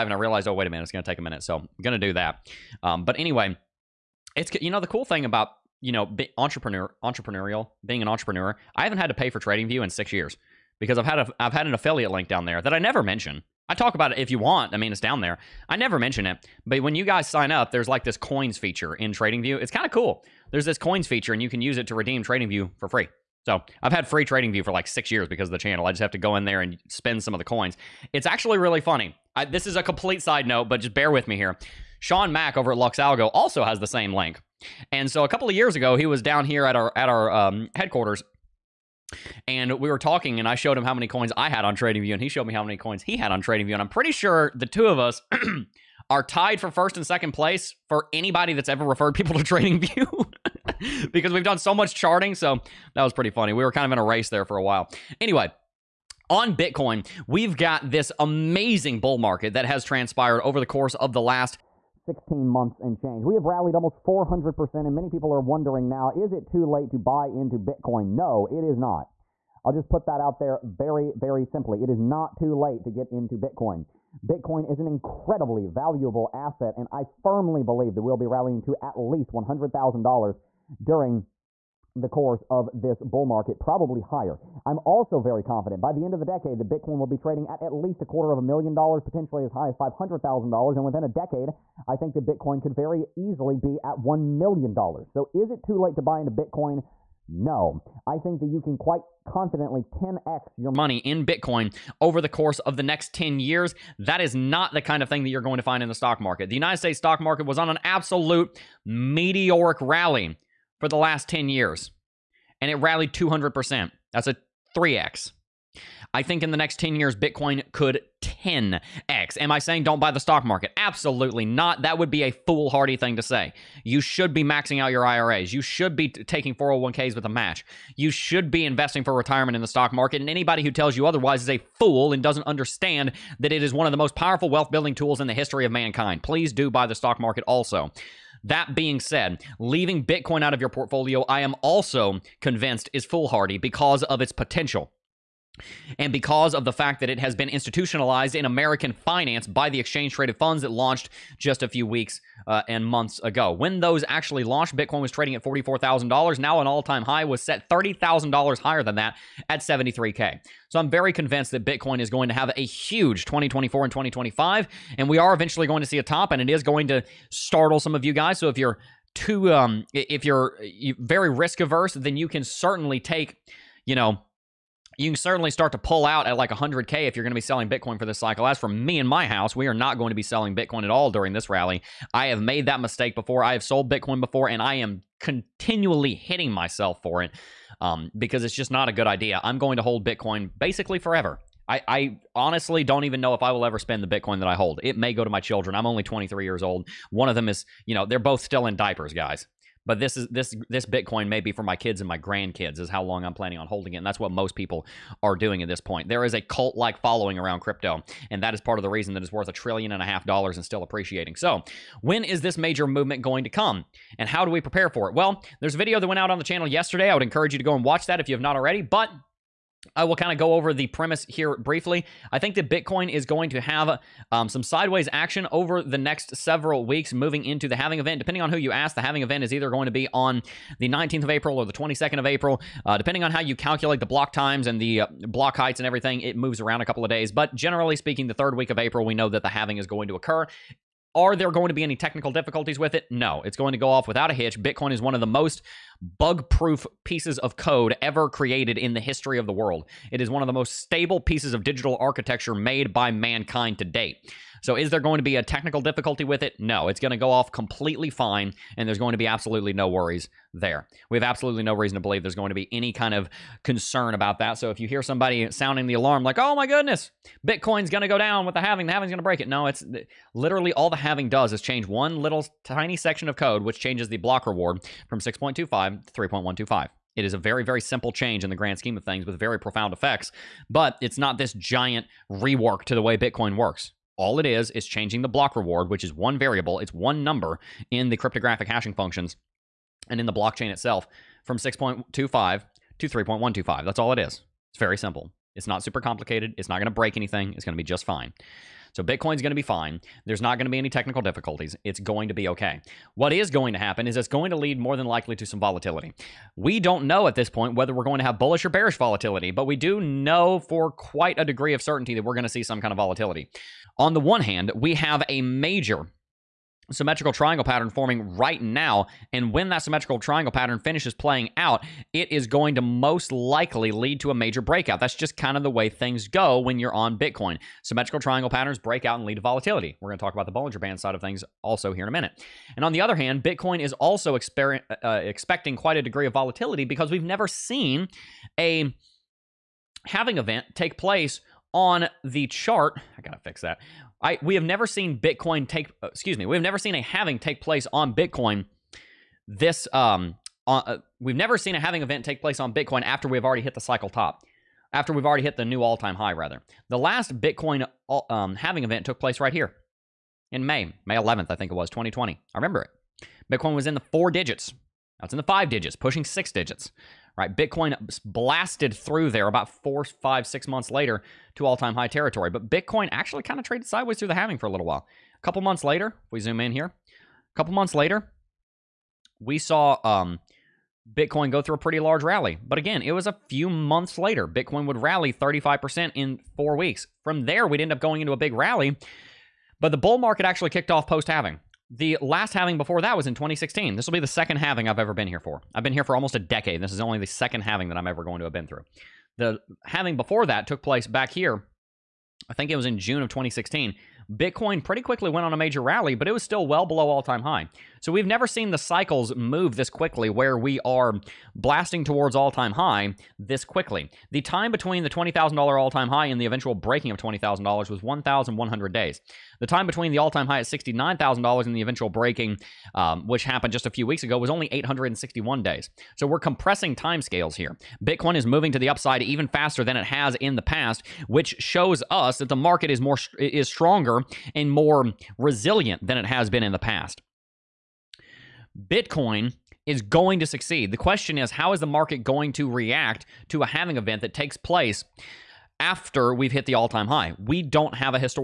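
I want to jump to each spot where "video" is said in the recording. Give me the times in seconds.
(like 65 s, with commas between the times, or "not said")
215 s.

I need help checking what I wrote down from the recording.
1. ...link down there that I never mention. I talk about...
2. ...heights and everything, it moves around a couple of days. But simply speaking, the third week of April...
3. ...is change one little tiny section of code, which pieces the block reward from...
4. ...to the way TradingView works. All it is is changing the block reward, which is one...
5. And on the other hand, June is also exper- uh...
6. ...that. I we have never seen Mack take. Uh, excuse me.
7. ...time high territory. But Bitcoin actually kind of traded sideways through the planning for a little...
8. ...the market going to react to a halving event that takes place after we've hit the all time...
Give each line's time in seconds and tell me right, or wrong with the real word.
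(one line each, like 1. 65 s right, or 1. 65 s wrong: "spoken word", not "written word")
1. 12 s right
2. 235 s wrong: "generally", not "simply"
3. 271 s wrong: "changes", not "pieces"
4. 282 s wrong: "Bitcoin", not "TradingView"
5. 332 s wrong: "Bitcoin", not "June"
6. 343 s wrong: "Bitcoin", not "Mack"
7. 371 s wrong: "halving", not "planning"
8. 441 s right.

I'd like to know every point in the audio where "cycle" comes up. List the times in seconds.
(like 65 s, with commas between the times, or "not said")
178 s, 353 s, 408 s.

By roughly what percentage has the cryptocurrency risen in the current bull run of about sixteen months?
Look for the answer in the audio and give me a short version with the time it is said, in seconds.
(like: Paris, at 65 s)
400%, at 64 s.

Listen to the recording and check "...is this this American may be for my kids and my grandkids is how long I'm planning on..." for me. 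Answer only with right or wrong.
wrong.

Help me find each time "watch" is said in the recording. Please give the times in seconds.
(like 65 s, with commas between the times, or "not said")
217 s.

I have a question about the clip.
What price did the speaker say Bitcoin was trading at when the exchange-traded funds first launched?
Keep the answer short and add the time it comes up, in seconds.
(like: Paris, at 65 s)
$44,000, at 155 s.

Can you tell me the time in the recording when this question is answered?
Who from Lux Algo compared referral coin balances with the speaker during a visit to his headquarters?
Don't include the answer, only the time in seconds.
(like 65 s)
31 s.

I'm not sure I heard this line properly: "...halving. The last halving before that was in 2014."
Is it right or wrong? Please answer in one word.
wrong.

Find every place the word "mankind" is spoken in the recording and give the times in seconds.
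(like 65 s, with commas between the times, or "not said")
135 s, 253 s.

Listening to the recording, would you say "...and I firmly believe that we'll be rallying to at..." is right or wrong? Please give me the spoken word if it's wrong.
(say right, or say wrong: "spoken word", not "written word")
right.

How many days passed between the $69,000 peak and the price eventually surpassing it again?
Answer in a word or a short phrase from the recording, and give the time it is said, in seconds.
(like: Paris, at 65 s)
861 days, at 424 s.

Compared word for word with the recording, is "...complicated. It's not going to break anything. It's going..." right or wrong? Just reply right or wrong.
right.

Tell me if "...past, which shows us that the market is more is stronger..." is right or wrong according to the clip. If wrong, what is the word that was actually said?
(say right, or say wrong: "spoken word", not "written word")
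right.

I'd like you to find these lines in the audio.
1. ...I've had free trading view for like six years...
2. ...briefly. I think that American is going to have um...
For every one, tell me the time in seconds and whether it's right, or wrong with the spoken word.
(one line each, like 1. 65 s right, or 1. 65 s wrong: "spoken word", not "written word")
1. 23 s right
2. 221 s wrong: "Bitcoin", not "American".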